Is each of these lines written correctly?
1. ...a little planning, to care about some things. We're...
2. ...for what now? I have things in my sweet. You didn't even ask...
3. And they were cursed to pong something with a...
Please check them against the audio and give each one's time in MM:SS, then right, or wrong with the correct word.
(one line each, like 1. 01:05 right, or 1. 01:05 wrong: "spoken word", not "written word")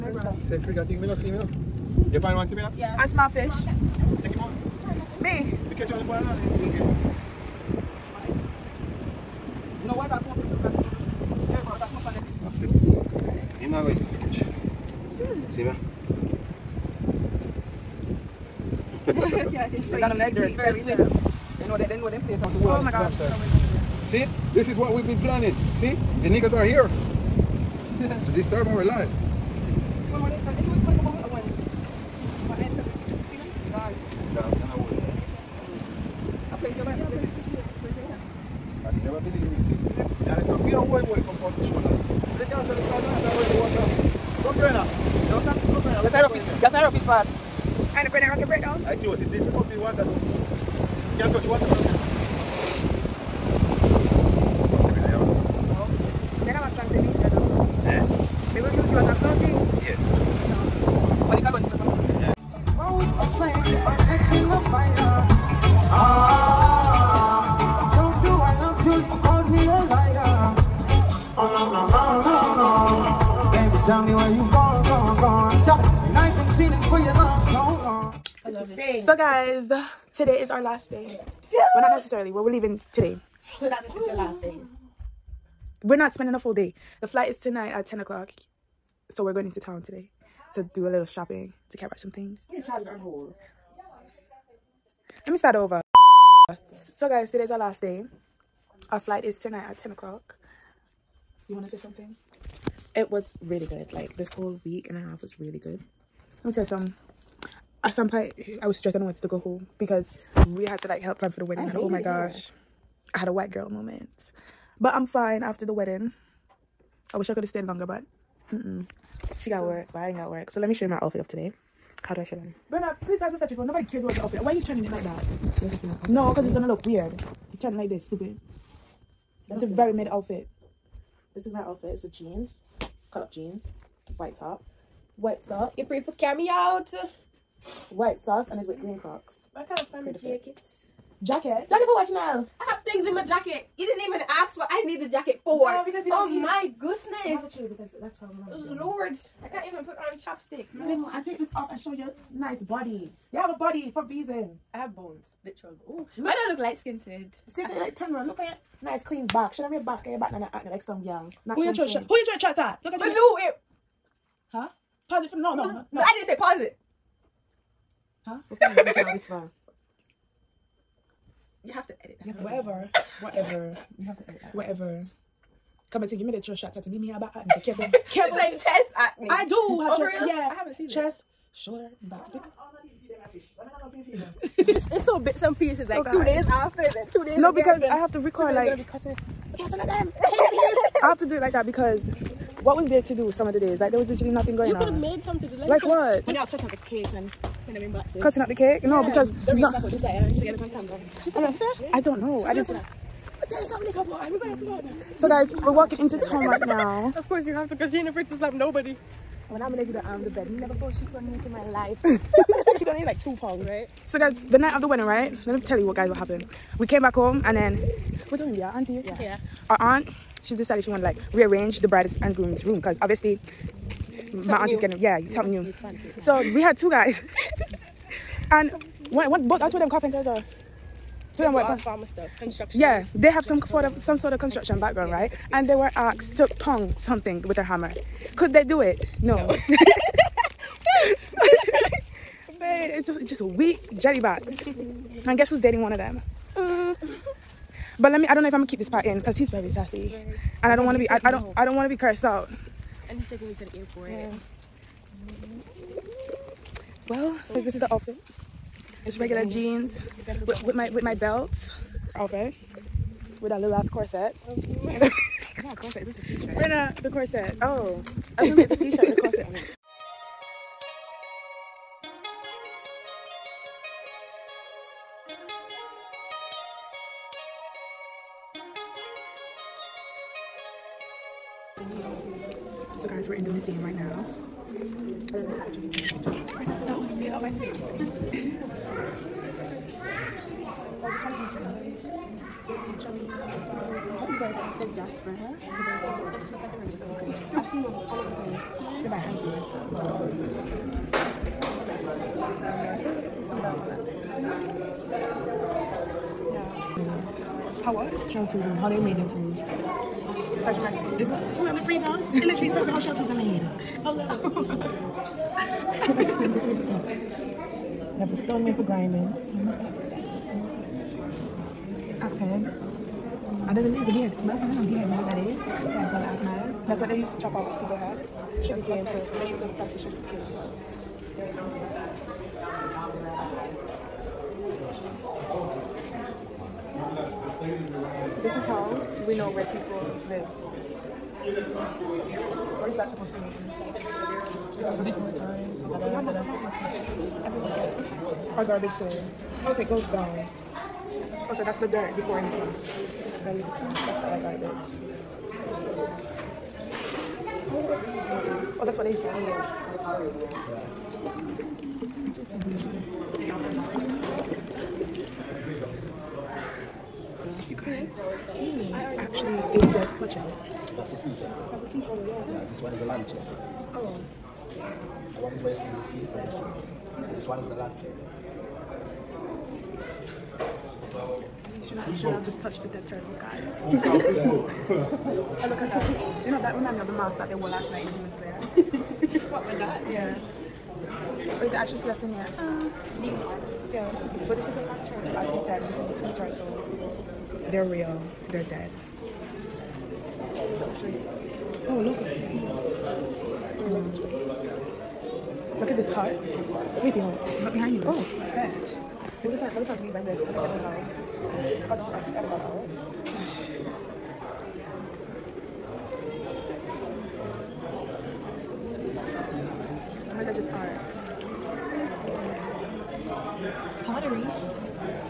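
1. 01:30 wrong: "shopping", not "planning"
2. 02:21 wrong: "jacket", not "sweet"
3. 03:55 wrong: "asked", not "cursed".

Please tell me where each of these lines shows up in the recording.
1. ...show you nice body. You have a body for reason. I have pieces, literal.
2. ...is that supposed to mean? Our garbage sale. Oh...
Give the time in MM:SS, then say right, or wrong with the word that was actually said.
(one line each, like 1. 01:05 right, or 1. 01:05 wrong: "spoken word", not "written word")
1. 02:31 wrong: "bones", not "pieces"
2. 05:42 right.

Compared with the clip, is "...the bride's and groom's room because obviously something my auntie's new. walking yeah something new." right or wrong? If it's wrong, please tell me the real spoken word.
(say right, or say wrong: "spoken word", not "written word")
wrong: "getting", not "walking".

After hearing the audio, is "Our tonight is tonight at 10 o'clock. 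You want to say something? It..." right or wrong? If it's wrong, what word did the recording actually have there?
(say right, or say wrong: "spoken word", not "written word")
wrong: "flight", not "tonight".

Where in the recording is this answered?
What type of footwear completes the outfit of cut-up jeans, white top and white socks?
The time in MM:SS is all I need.
02:18.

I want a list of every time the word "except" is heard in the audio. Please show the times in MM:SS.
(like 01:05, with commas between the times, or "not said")
not said.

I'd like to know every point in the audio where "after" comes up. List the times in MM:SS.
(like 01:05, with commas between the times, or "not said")
01:55, 03:06.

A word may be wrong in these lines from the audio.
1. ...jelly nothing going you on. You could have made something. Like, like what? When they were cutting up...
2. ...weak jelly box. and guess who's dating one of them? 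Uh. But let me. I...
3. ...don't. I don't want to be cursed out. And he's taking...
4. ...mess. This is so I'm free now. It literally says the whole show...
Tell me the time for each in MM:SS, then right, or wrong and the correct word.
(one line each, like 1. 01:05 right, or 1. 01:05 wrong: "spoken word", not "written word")
1. 03:14 wrong: "literally", not "jelly"
2. 04:03 right
3. 04:11 right
4. 05:10 right.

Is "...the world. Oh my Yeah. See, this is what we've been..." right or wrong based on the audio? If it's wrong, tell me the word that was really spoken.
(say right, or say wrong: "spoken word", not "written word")
wrong: "God", not "Yeah".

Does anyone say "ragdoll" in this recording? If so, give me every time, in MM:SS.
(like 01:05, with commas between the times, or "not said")
not said.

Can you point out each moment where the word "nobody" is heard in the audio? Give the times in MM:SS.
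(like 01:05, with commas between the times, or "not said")
02:03, 03:28.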